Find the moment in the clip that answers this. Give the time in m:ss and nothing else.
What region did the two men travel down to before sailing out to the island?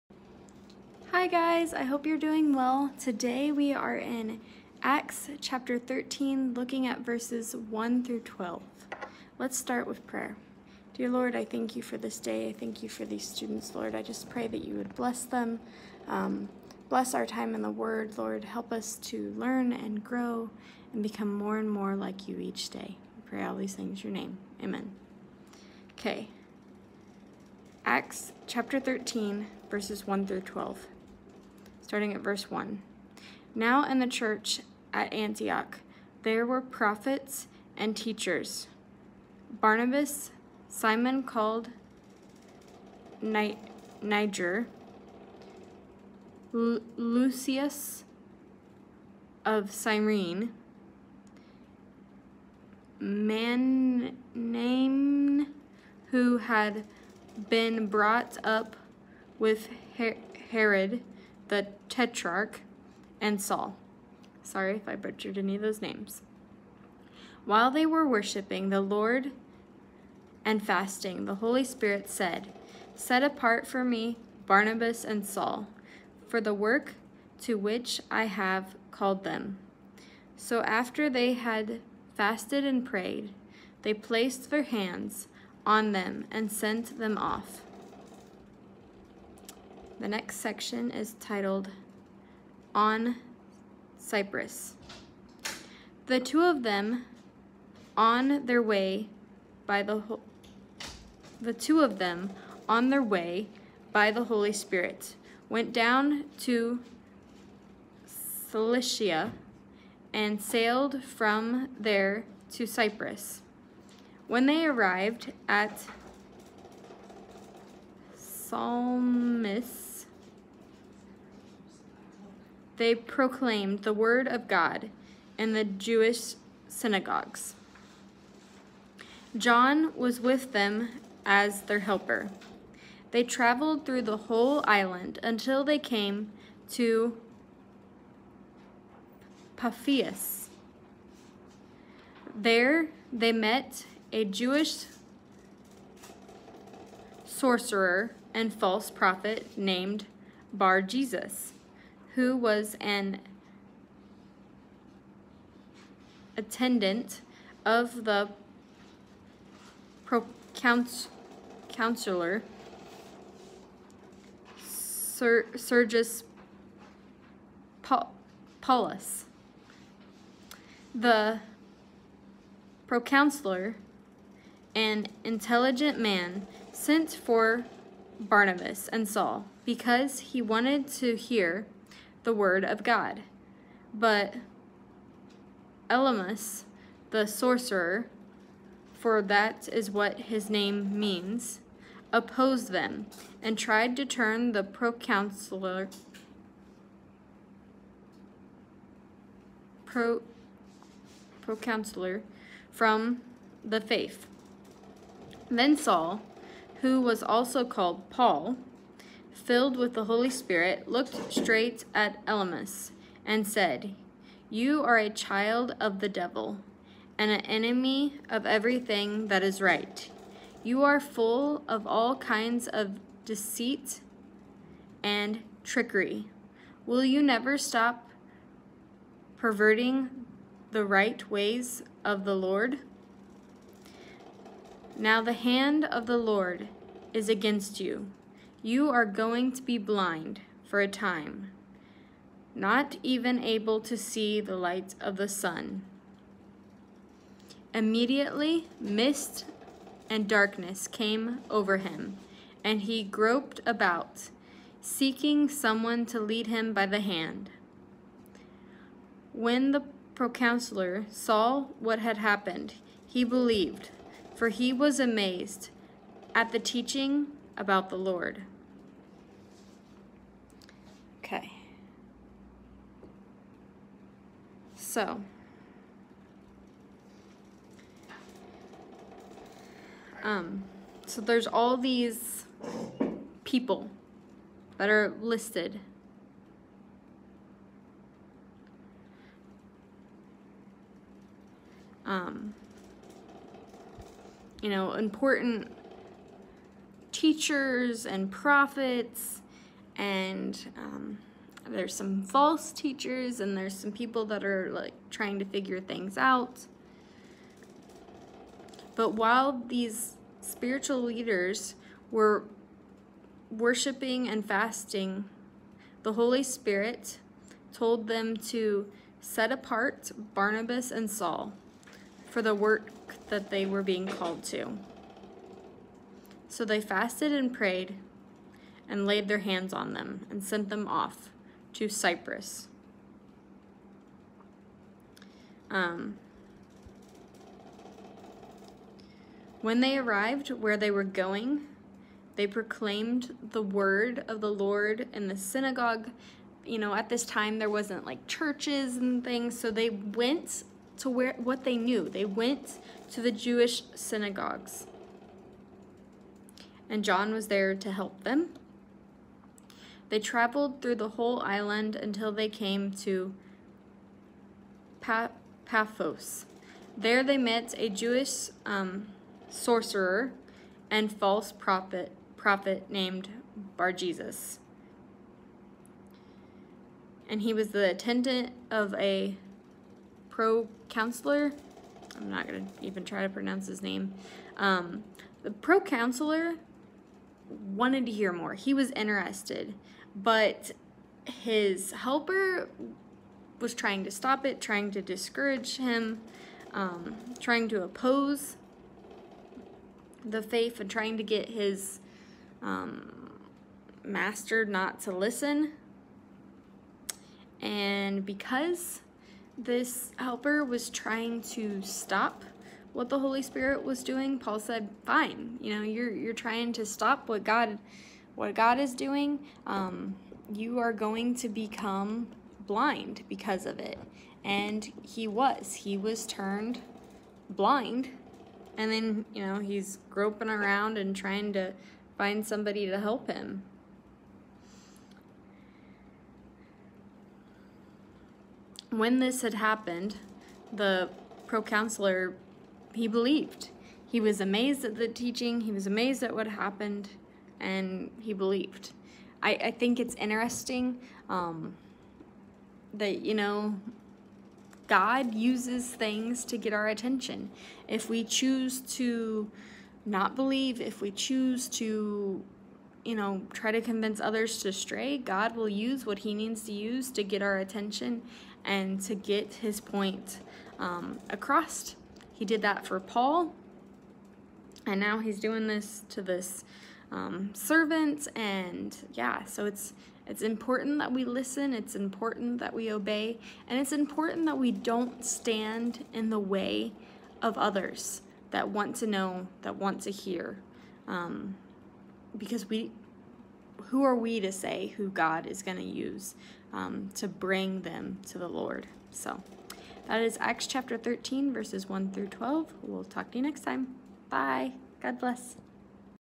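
1:48.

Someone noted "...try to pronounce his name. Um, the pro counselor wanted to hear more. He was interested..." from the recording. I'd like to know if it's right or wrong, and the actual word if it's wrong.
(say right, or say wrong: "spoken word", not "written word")
right.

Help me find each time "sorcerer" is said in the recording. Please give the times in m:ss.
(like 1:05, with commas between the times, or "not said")
2:27, 3:07, 6:09.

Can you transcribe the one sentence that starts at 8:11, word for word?
Um, because we, who are we to say who God is going to use um, to bring them to the Lord?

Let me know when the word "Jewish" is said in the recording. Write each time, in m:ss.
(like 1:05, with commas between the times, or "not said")
2:05, 2:24, 5:53, 6:07.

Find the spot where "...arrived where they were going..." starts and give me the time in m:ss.
5:39.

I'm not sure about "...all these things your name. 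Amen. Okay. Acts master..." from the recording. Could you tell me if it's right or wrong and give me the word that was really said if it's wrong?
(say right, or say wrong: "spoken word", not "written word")
wrong: "chapter", not "master".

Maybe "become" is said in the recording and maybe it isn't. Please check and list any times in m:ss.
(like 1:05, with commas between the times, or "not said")
0:21, 7:01.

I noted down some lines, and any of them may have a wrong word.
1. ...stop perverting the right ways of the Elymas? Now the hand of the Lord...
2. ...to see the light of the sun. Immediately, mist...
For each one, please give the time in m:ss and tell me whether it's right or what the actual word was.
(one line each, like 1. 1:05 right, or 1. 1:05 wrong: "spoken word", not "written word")
1. 3:47 wrong: "Lord", not "Elymas"
2. 4:03 right.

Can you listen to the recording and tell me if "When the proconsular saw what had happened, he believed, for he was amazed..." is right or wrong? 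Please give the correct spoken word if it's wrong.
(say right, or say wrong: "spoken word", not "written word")
right.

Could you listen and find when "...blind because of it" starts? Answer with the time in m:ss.
7:02.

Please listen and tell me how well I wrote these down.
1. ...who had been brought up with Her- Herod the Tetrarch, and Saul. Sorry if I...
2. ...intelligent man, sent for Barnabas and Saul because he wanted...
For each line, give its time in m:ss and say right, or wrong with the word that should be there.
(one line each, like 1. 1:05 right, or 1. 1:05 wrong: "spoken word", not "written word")
1. 0:56 right
2. 2:55 right.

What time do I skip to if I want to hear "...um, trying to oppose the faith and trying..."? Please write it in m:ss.
6:36.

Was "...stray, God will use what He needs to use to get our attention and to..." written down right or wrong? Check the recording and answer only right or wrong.
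right.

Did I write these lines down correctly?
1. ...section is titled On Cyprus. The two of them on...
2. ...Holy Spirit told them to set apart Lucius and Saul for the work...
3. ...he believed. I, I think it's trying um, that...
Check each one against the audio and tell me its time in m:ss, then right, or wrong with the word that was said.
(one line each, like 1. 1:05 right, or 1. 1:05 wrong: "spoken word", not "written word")
1. 1:30 right
2. 5:16 wrong: "Barnabas", not "Lucius"
3. 7:28 wrong: "interesting", not "trying".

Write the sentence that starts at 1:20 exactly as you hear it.
So after they had fasted and prayed, they placed their hands on them and sent them off.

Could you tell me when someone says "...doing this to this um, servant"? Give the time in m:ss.
7:55.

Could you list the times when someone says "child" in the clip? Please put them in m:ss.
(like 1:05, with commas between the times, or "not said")
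3:35.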